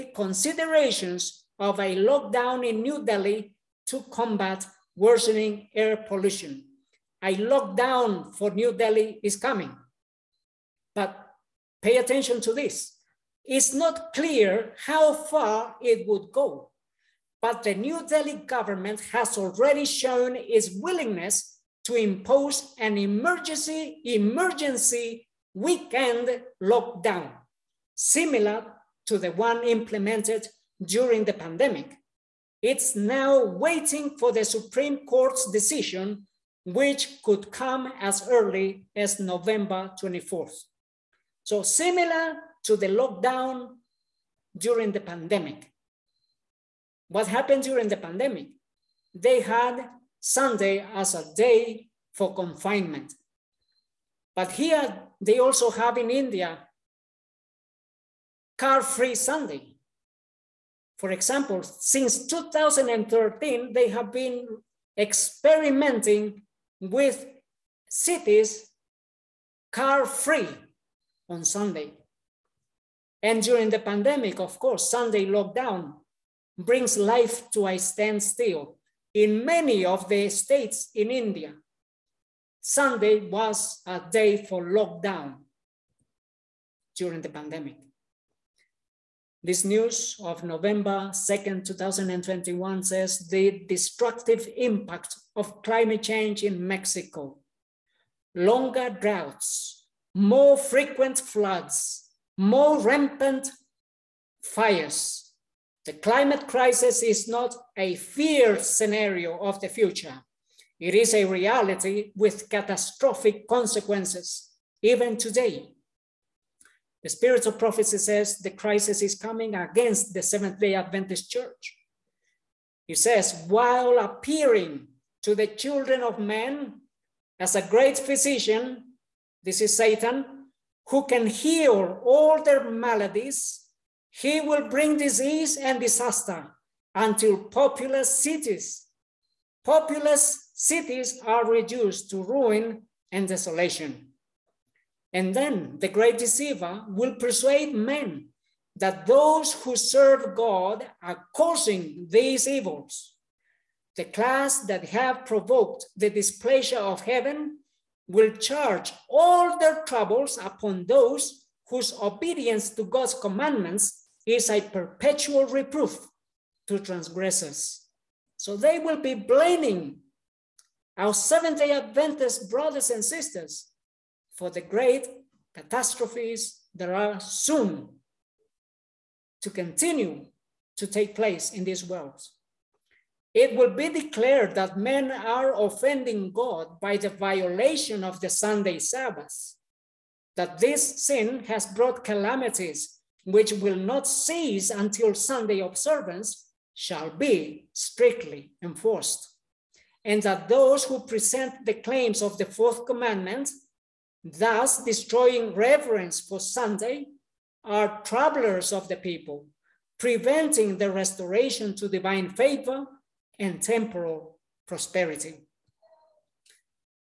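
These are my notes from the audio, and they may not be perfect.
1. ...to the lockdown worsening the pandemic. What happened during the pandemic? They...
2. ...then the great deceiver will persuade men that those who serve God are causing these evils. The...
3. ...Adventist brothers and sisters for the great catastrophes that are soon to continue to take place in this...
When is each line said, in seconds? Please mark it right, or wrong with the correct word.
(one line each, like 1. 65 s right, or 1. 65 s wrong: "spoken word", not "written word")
1. 42 s wrong: "during", not "worsening"
2. 145 s right
3. 171 s right.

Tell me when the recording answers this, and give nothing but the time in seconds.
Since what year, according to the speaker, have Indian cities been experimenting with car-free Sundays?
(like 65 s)
62 s.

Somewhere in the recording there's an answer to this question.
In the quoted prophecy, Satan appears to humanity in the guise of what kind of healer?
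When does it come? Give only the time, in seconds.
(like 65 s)
127 s.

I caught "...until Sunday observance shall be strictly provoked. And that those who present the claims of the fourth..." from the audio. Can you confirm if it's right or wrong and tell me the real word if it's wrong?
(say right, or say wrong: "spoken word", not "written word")
wrong: "enforced", not "provoked".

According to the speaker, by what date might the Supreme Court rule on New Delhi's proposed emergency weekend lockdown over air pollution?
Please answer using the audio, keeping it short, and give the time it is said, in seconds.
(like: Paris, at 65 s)
November 24th, at 39 s.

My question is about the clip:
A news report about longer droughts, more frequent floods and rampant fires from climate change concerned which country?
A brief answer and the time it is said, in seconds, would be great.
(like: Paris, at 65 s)
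Mexico, at 96 s.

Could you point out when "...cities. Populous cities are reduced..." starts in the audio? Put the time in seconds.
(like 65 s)
138 s.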